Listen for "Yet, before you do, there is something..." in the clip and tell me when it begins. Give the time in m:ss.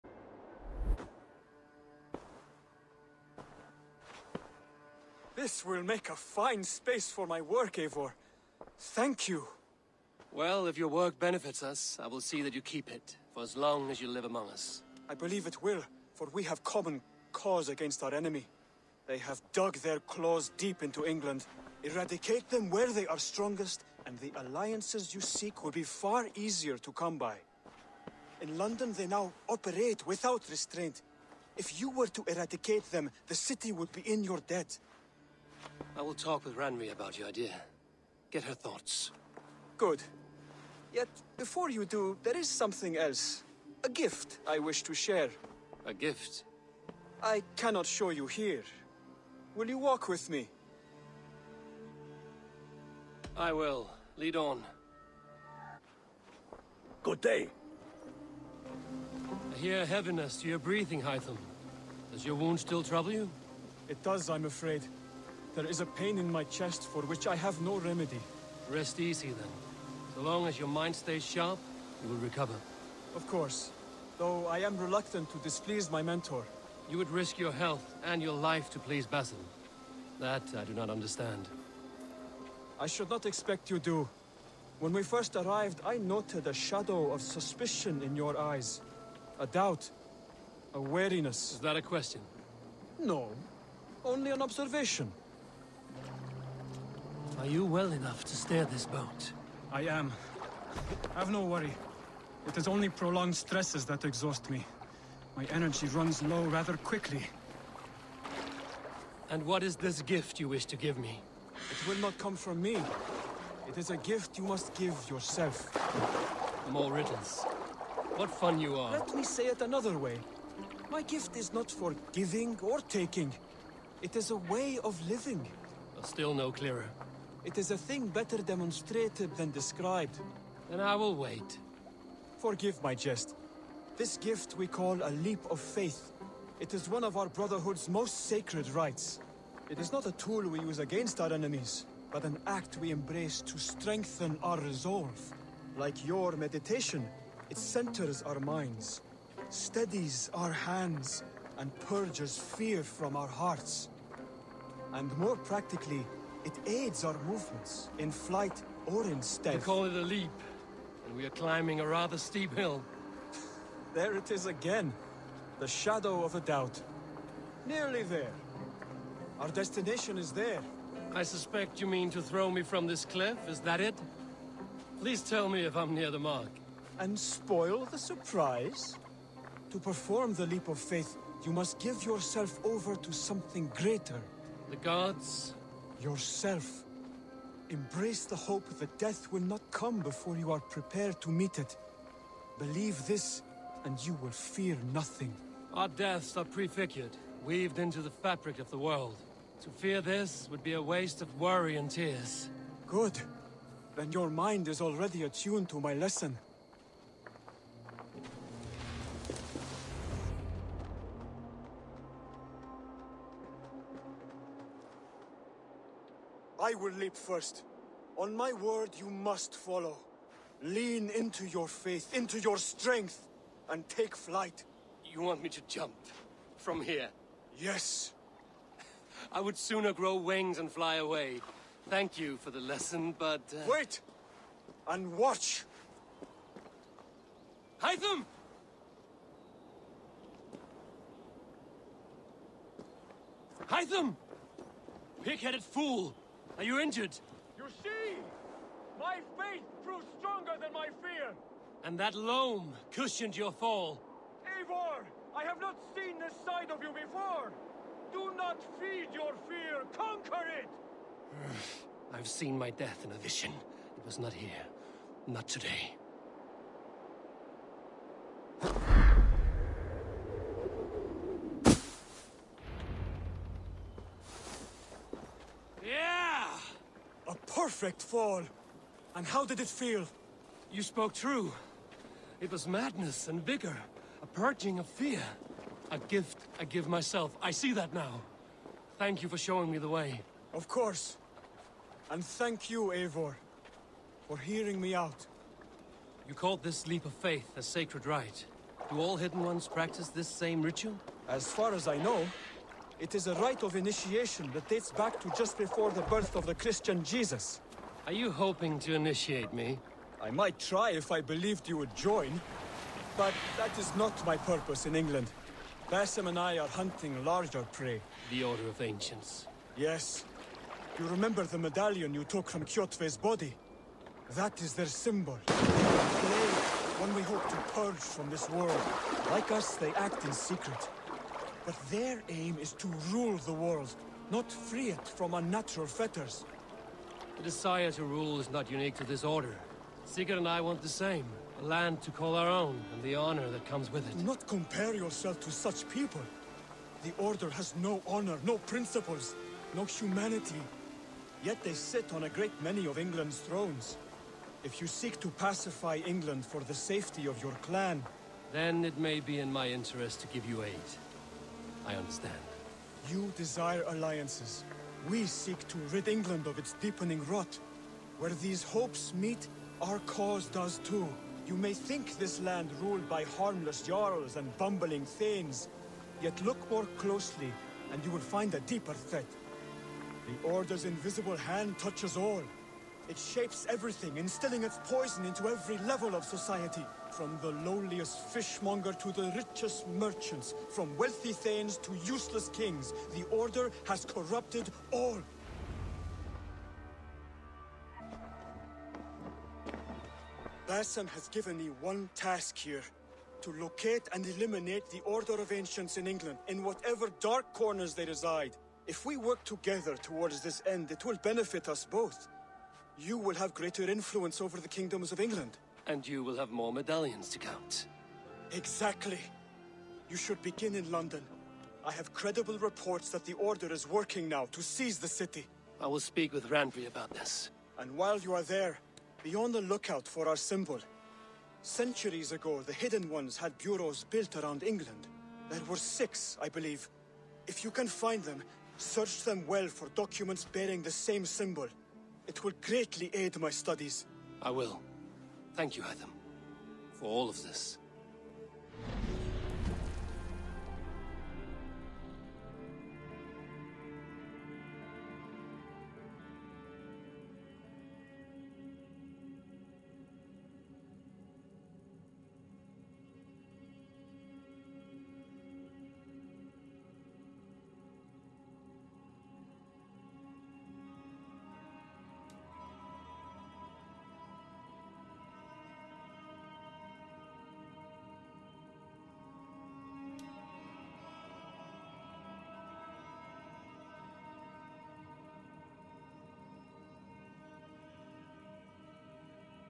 0:40.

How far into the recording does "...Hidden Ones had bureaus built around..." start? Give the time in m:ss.
7:12.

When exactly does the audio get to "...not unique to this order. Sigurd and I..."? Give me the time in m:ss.
5:38.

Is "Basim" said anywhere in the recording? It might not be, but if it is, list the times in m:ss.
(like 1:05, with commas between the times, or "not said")
1:19, 5:15, 6:40.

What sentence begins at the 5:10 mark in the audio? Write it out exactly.
I might try if I believed you would join.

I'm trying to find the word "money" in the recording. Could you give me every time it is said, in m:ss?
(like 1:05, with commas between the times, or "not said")
not said.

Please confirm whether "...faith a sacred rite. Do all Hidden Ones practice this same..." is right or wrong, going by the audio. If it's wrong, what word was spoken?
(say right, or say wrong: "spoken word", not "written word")
right.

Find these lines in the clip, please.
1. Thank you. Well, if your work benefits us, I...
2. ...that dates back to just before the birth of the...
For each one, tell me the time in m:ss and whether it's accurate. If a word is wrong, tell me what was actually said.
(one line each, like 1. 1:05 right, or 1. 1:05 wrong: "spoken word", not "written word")
1. 0:08 right
2. 5:04 right.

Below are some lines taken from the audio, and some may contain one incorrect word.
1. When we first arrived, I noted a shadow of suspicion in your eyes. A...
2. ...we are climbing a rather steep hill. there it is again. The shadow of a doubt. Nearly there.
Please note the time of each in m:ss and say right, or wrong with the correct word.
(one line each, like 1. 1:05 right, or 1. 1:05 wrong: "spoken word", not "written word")
1. 1:24 right
2. 2:41 right.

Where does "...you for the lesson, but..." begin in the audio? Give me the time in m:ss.
3:52.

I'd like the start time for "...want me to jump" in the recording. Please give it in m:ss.
3:45.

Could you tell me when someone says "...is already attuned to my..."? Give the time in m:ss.
3:24.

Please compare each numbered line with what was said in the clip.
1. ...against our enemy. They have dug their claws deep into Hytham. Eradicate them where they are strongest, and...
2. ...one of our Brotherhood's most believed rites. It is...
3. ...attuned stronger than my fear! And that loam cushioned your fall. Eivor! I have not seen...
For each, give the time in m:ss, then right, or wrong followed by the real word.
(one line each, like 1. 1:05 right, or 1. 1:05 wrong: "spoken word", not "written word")
1. 0:17 wrong: "England", not "Hytham"
2. 2:16 wrong: "sacred", not "believed"
3. 4:09 wrong: "proved", not "attuned".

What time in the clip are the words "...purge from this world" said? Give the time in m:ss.
5:27.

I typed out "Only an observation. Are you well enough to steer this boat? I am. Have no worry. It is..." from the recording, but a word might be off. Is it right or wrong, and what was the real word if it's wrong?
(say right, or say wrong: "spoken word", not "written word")
right.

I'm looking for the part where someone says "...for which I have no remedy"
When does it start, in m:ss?
1:06.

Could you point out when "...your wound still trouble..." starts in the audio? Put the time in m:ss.
1:02.